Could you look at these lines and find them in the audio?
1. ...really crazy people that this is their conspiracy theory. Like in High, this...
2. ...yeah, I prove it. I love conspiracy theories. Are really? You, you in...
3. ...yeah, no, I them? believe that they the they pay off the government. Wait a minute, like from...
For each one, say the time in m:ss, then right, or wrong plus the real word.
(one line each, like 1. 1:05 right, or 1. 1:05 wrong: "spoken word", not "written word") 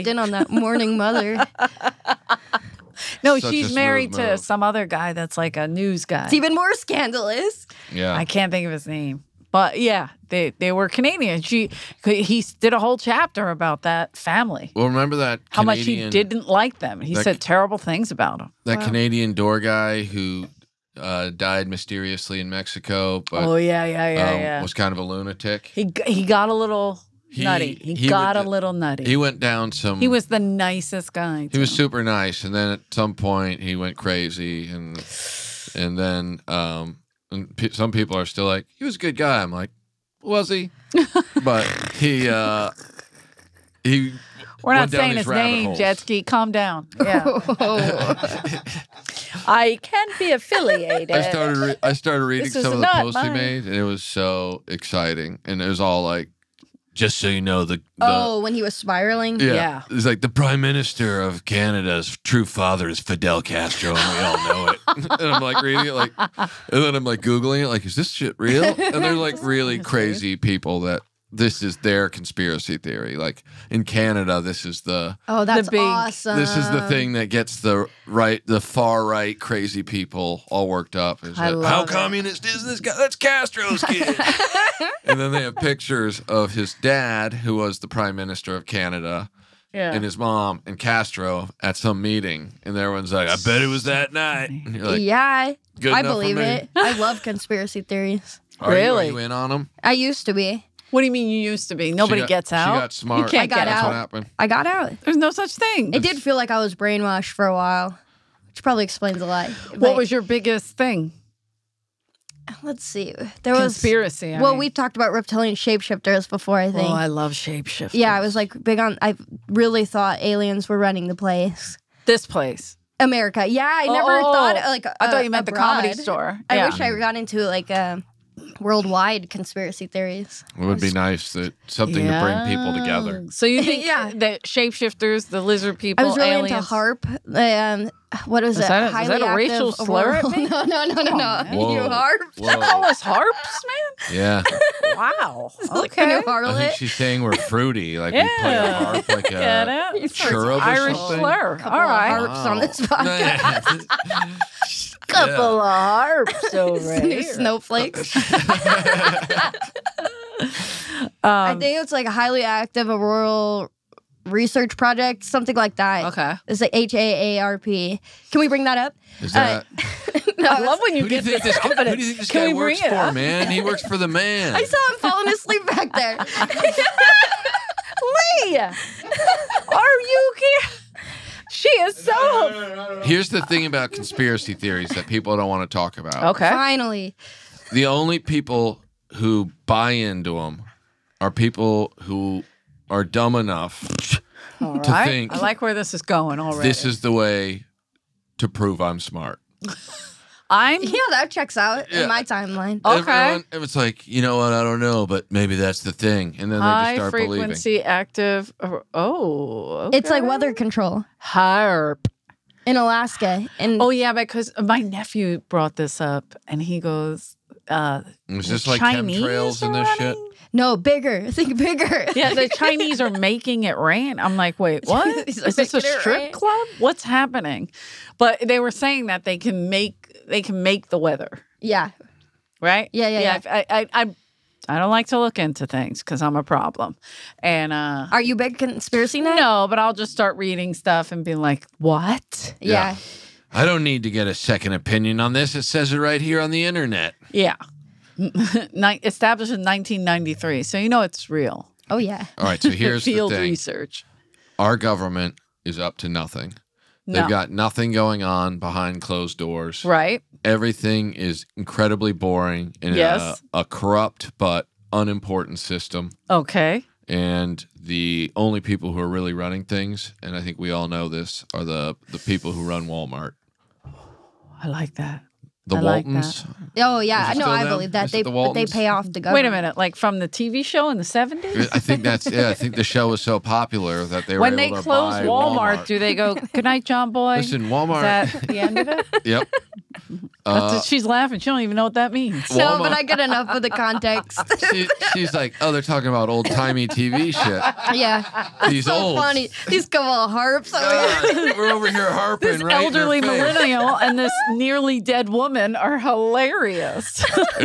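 1. 1:09 wrong: "Canada", not "High"
2. 1:34 wrong: "believe", not "prove"
3. 4:36 right.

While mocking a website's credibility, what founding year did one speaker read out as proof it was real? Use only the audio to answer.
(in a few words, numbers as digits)
1993.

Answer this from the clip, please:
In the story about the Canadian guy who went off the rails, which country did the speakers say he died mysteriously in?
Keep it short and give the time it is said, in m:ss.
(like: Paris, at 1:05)
Mexico, at 0:22.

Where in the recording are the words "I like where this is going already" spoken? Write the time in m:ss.
3:15.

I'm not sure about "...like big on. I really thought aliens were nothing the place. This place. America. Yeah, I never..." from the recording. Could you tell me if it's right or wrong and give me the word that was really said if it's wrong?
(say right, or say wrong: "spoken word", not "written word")
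wrong: "running", not "nothing".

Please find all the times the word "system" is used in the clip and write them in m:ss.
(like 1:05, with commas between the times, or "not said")
4:25.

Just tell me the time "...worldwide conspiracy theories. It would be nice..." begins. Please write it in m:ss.
2:08.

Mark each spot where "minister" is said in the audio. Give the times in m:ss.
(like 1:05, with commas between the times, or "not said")
1:00, 1:28.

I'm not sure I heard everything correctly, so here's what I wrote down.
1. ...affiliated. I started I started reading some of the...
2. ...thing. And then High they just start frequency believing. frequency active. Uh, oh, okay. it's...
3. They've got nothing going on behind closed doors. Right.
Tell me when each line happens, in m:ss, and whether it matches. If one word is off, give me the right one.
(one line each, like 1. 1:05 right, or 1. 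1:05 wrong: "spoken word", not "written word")
1. 0:50 right
2. 3:25 right
3. 4:17 right.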